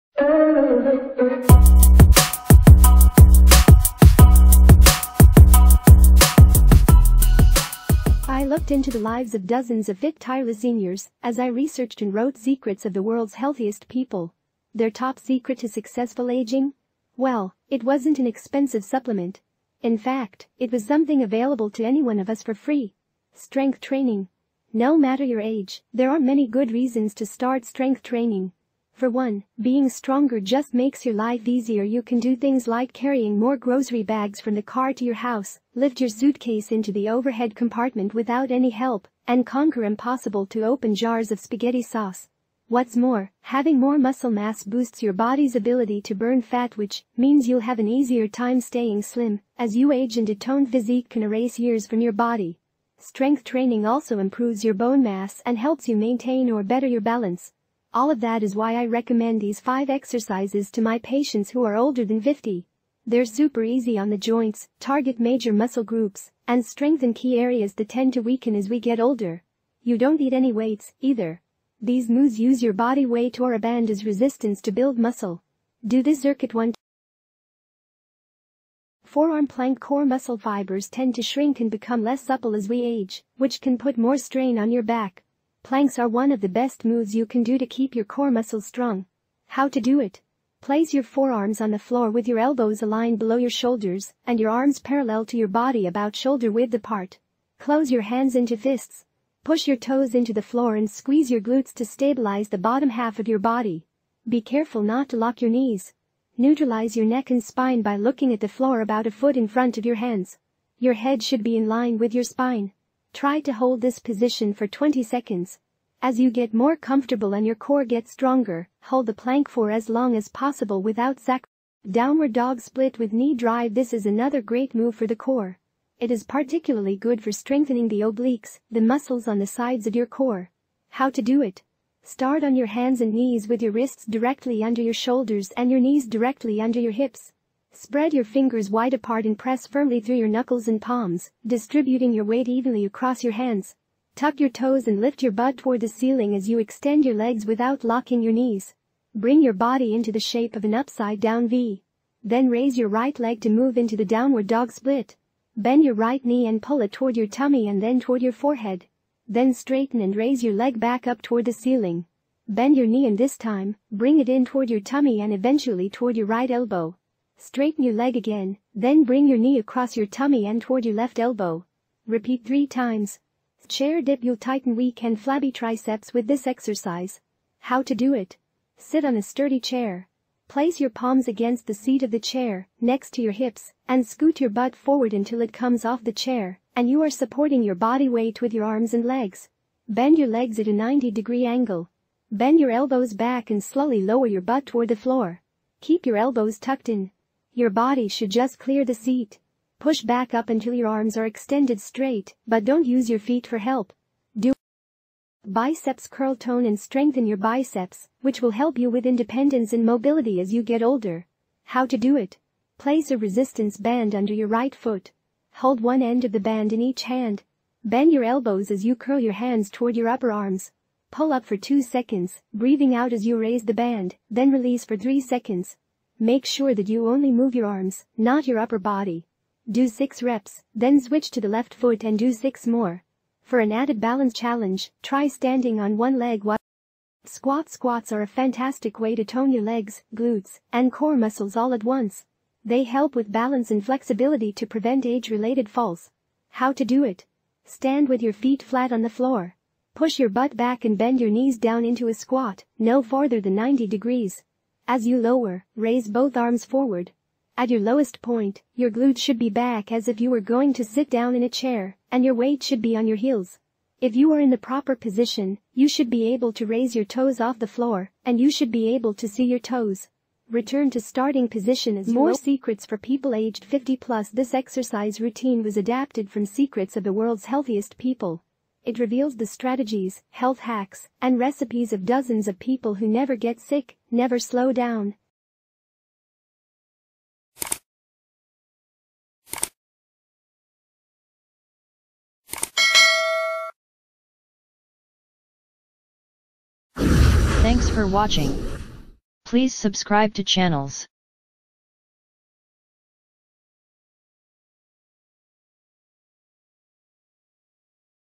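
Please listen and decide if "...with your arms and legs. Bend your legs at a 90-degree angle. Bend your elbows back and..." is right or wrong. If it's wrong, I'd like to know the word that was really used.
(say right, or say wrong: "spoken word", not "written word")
right.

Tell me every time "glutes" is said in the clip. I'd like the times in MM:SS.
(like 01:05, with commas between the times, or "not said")
01:41, 04:00, 04:18.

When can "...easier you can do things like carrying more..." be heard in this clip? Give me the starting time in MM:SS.
00:31.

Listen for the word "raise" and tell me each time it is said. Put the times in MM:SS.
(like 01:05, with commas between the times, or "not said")
02:32, 02:40, 03:43, 04:15, 04:26.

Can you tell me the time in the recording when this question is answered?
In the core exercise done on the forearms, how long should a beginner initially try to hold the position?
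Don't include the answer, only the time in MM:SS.
01:54.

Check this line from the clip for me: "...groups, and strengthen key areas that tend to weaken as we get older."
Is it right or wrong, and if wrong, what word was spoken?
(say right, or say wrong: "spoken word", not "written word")
right.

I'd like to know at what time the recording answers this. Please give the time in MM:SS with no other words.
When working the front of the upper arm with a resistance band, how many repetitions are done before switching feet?
03:49.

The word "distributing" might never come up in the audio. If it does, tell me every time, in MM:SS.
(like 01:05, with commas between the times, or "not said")
02:21.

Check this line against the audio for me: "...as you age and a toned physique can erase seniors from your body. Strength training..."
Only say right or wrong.
wrong.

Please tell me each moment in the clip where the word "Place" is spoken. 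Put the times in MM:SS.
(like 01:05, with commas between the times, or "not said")
01:30, 03:00, 03:32.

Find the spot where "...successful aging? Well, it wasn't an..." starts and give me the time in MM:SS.
00:15.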